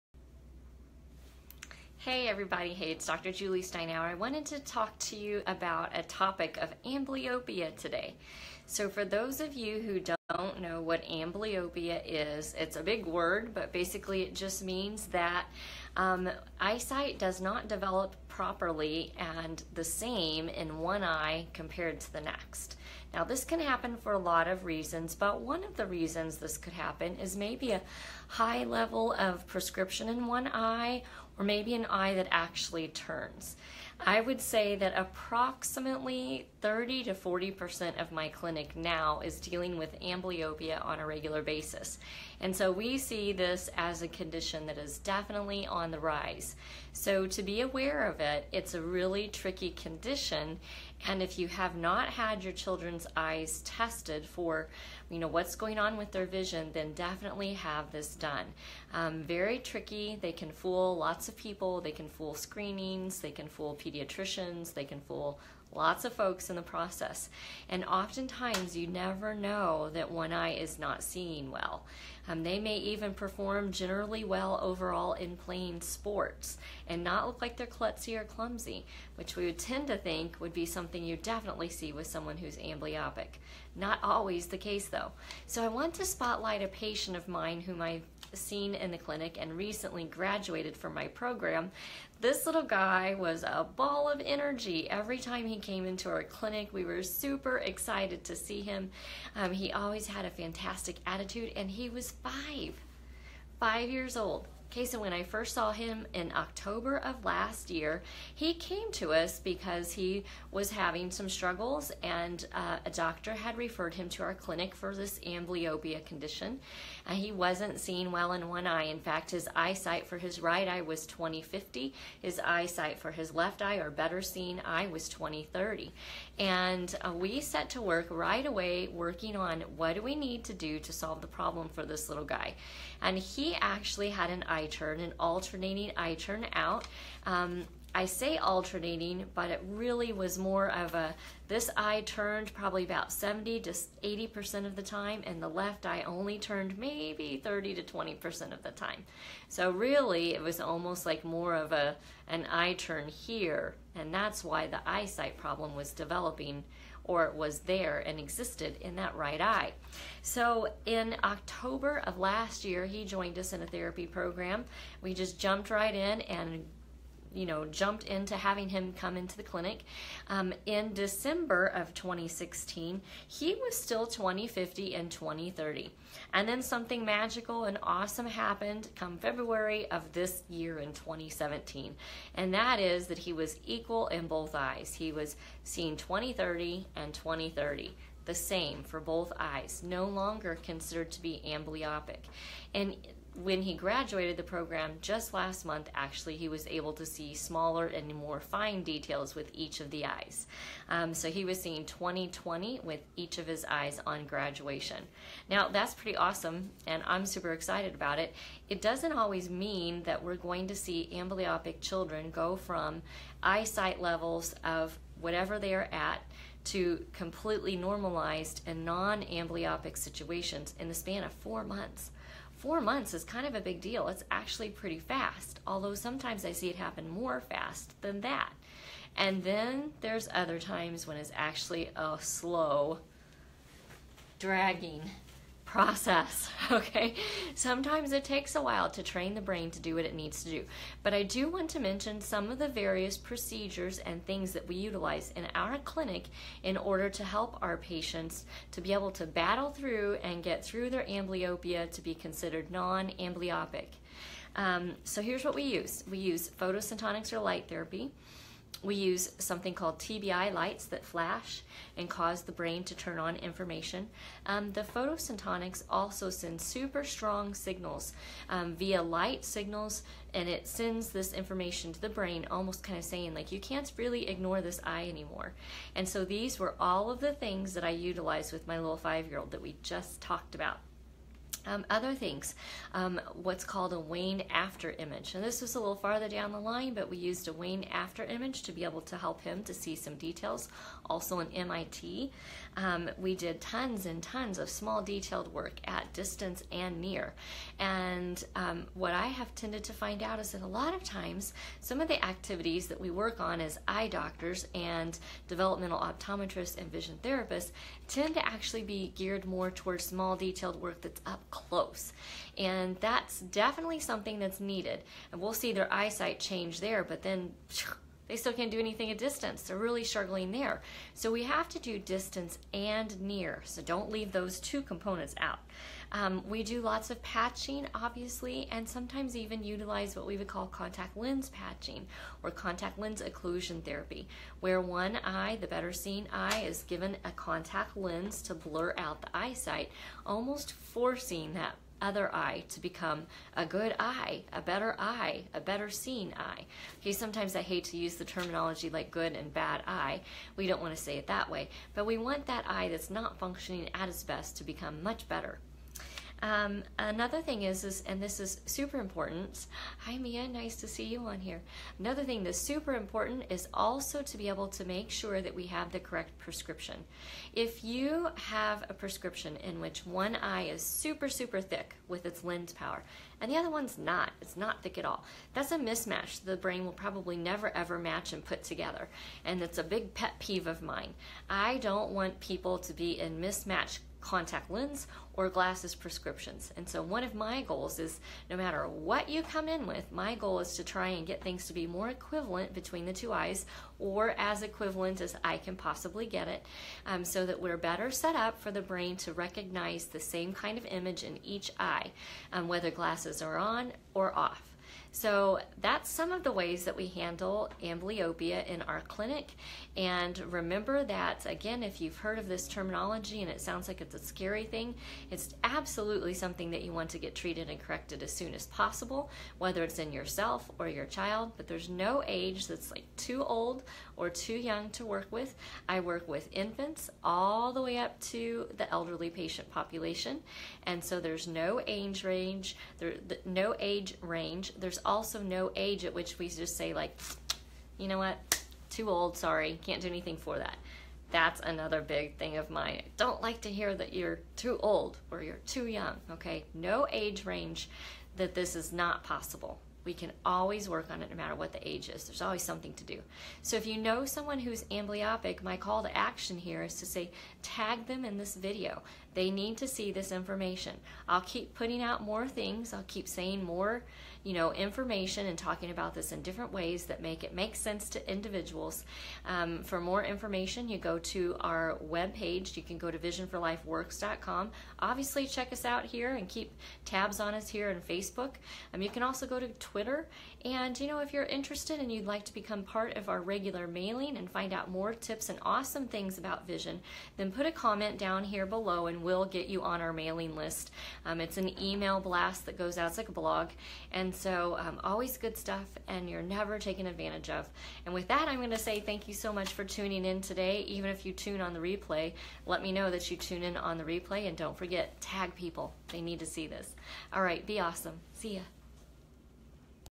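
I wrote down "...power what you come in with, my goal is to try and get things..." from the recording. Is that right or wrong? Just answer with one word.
wrong.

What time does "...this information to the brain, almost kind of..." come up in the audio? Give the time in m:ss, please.
4:31.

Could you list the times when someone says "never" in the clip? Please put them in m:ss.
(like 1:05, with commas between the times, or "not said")
1:08, 6:17, 8:16.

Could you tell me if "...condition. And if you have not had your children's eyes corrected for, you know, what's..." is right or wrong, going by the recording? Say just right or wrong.
wrong.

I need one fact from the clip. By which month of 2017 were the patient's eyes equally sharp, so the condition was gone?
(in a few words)
February.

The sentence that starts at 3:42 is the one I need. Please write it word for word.
Four months is kind of a big deal.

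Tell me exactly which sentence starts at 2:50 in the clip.
Um, in December of 2016, he was still 2050 and 2030.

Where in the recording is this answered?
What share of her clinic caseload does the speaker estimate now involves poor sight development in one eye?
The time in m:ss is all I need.
0:36.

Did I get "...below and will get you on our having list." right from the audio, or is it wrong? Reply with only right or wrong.
wrong.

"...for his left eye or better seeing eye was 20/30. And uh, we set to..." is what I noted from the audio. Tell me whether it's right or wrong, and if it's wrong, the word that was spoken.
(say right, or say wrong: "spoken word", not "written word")
right.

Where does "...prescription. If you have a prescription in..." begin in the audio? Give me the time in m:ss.
6:06.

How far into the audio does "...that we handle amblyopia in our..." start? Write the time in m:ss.
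6:46.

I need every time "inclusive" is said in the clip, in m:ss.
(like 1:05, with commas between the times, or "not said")
not said.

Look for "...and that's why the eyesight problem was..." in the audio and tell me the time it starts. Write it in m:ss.
2:33.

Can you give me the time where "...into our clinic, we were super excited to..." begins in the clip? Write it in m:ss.
1:35.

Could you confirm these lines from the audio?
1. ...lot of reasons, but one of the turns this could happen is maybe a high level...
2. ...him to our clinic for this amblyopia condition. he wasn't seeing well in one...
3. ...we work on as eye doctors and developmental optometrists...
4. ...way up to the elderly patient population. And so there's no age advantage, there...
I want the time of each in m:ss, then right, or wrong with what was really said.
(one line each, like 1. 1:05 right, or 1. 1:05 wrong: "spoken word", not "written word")
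1. 0:24 wrong: "reasons", not "turns"
2. 1:53 right
3. 5:02 right
4. 7:07 wrong: "range", not "advantage".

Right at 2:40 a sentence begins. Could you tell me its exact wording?
So in October of last year, he joined us in a therapy program.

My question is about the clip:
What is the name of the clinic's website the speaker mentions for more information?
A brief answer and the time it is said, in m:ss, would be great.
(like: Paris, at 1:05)
visionforlifeworks.com, at 7:53.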